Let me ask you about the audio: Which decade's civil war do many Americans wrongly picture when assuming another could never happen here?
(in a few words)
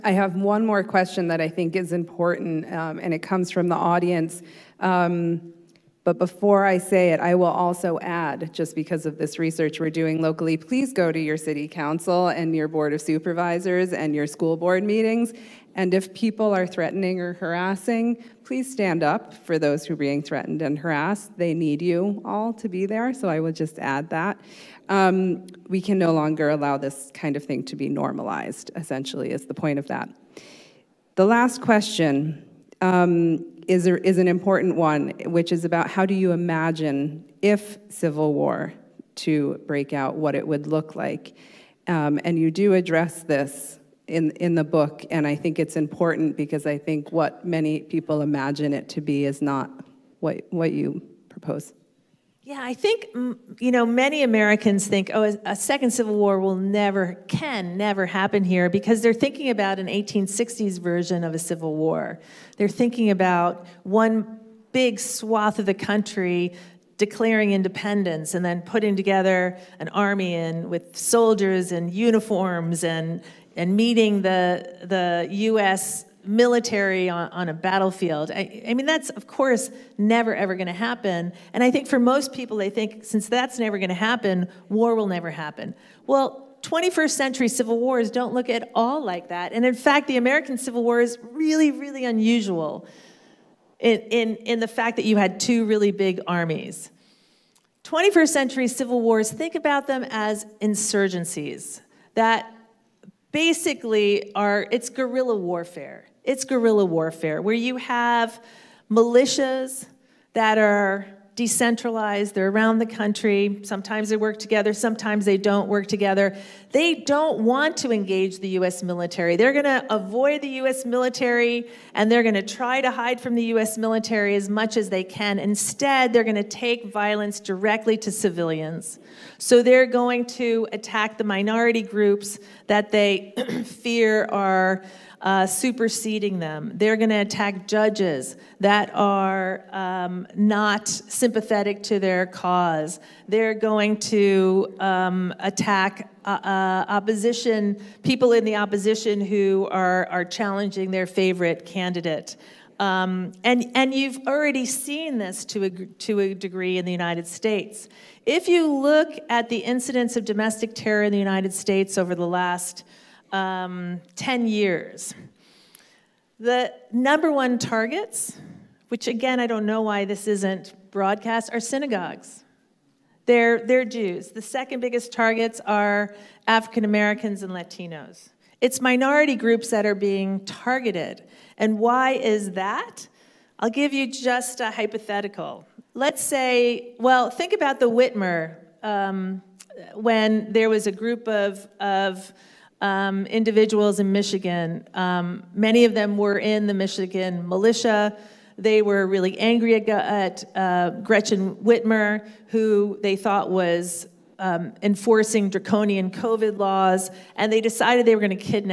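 1860s.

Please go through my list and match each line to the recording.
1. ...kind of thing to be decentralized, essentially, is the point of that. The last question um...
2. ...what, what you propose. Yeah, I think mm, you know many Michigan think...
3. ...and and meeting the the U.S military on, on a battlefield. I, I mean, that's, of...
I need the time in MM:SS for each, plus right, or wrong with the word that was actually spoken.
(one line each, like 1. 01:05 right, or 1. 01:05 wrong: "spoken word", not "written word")
1. 00:27 wrong: "normalized", not "decentralized"
2. 00:50 wrong: "Americans", not "Michigan"
3. 01:12 right.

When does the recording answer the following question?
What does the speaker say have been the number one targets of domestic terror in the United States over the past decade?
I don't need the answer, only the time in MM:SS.
02:51.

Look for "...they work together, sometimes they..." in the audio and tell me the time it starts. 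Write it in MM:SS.
01:54.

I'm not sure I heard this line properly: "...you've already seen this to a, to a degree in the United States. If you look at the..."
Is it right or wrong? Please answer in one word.
right.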